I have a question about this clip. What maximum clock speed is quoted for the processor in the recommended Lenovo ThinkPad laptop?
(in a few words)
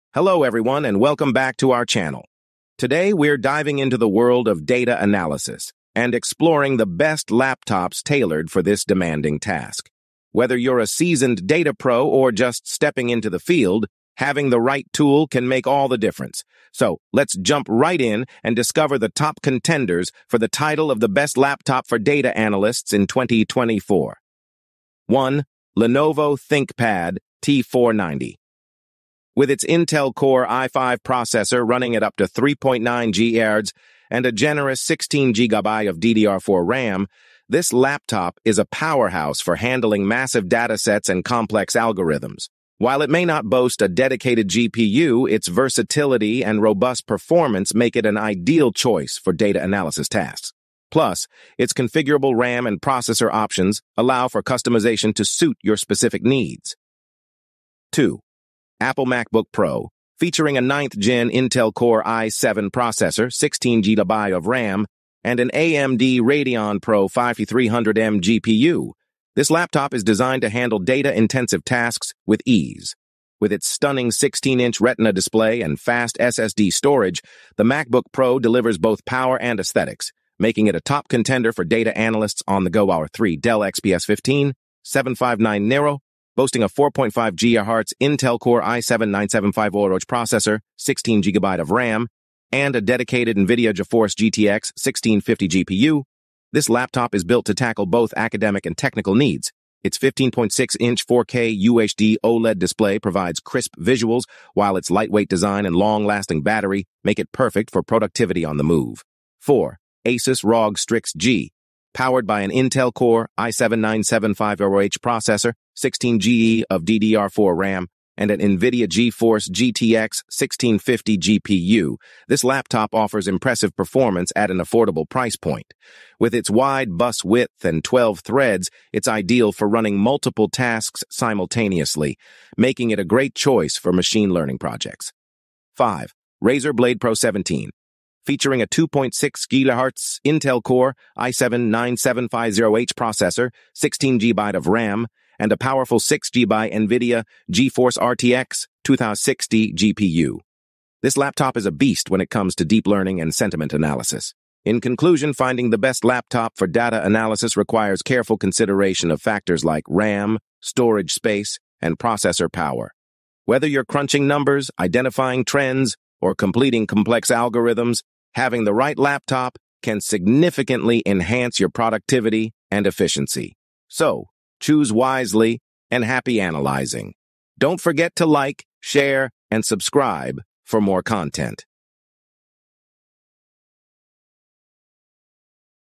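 3.9 GHz.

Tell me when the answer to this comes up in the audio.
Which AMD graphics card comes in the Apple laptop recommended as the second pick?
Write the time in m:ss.
1:05.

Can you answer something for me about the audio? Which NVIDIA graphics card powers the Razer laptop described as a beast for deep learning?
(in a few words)
GeForce RTX 2060.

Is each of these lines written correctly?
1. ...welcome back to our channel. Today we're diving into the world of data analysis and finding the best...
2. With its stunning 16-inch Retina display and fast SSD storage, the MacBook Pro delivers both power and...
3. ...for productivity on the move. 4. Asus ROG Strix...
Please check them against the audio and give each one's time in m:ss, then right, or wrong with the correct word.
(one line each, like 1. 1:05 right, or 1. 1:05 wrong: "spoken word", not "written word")
1. 0:00 wrong: "exploring", not "finding"
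2. 1:13 right
3. 1:47 right.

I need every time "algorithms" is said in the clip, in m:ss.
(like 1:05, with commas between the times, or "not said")
0:41, 2:47.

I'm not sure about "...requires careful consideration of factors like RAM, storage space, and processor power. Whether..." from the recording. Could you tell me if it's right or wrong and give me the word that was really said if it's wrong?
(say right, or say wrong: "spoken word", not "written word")
right.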